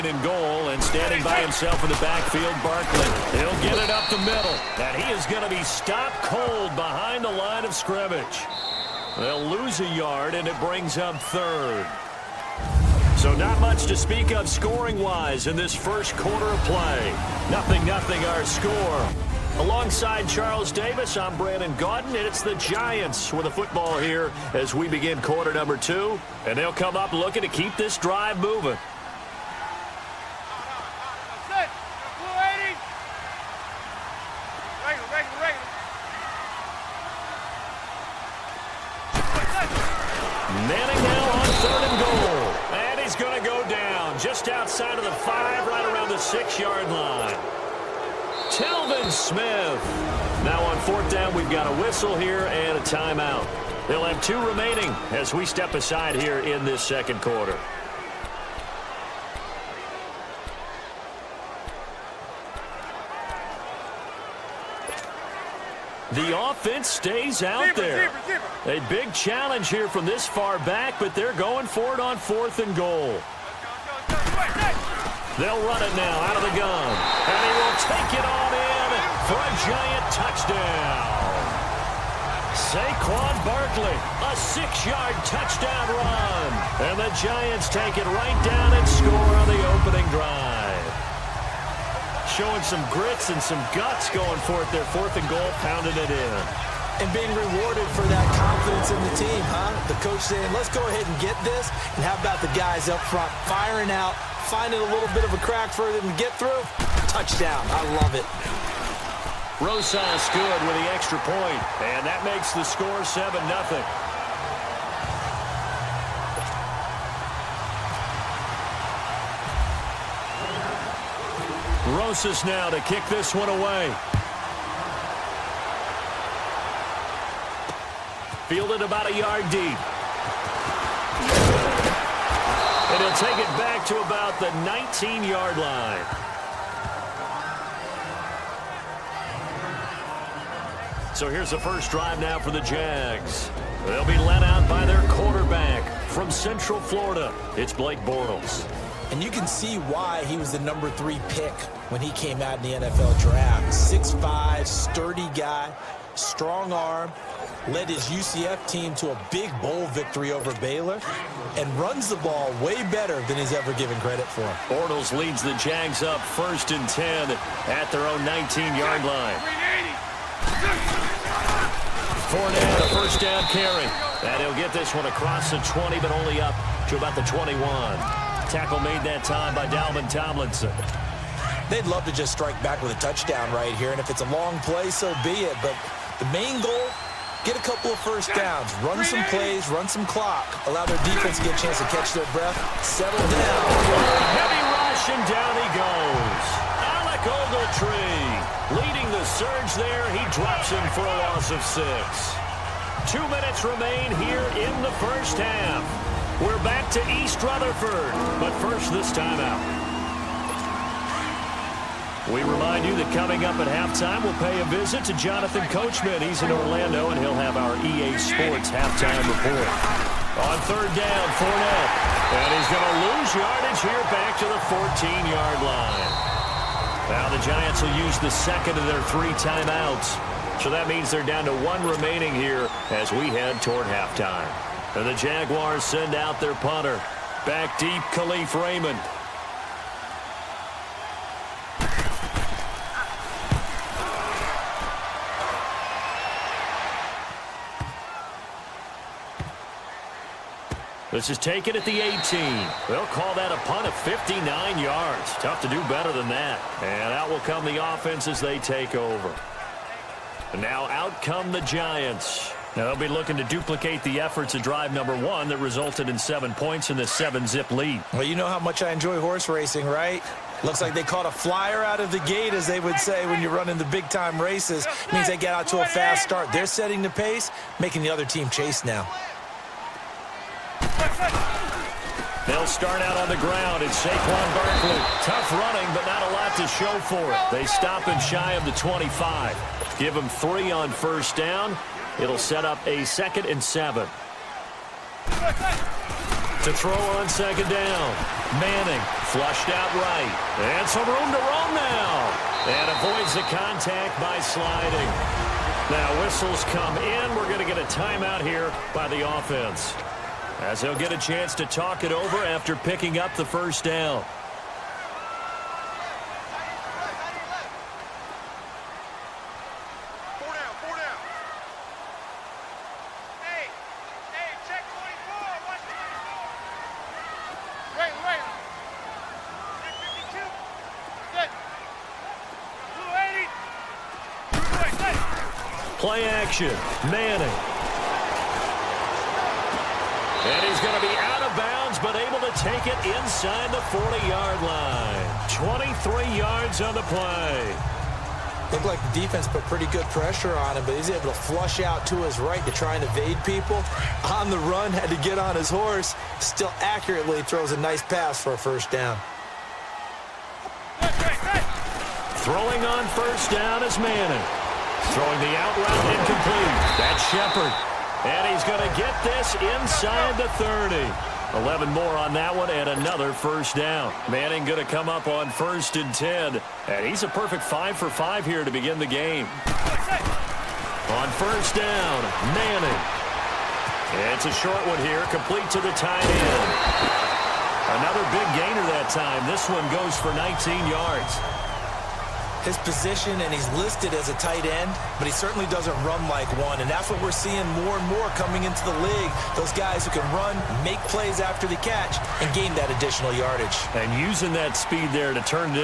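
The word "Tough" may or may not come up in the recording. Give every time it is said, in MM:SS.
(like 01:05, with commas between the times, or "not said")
04:15, 04:45.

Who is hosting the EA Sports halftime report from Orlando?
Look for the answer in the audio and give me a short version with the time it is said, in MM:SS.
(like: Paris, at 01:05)
Jonathan Coachman, at 03:35.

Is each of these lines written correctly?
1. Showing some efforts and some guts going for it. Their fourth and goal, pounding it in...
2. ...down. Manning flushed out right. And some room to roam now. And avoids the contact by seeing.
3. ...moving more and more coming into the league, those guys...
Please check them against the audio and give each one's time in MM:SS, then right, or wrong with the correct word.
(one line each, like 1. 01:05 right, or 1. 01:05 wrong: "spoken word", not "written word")
1. 01:32 wrong: "grits", not "efforts"
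2. 04:57 wrong: "sliding", not "seeing"
3. 06:37 wrong: "seeing", not "moving".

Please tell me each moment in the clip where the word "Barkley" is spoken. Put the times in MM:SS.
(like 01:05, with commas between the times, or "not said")
00:02, 01:23, 04:44.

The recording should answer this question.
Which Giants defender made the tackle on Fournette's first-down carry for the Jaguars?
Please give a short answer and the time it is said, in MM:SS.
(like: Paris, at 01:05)
Dalvin Tomlinson, at 02:59.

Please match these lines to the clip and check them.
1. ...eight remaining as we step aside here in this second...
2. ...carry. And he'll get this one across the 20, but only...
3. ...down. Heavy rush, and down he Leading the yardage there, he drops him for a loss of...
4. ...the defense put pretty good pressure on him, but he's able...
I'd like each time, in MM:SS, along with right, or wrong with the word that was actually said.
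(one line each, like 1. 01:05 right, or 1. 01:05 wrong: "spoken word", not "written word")
1. 00:54 wrong: "two", not "eight"
2. 02:53 right
3. 03:13 wrong: "surge", not "yardage"
4. 05:49 right.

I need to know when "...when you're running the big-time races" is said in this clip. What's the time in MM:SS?
04:33.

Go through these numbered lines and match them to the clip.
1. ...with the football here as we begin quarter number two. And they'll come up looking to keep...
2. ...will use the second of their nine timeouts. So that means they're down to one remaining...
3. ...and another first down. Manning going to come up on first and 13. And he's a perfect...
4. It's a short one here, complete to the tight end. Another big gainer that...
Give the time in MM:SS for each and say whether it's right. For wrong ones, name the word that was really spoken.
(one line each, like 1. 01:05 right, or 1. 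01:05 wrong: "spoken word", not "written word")
1. 00:23 right
2. 03:47 wrong: "three", not "nine"
3. 06:12 wrong: "10", not "13"
4. 06:24 right.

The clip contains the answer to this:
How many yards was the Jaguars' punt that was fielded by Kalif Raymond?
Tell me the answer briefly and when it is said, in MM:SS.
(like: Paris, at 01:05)
59, at 04:13.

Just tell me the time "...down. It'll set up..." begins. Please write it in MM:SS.
04:51.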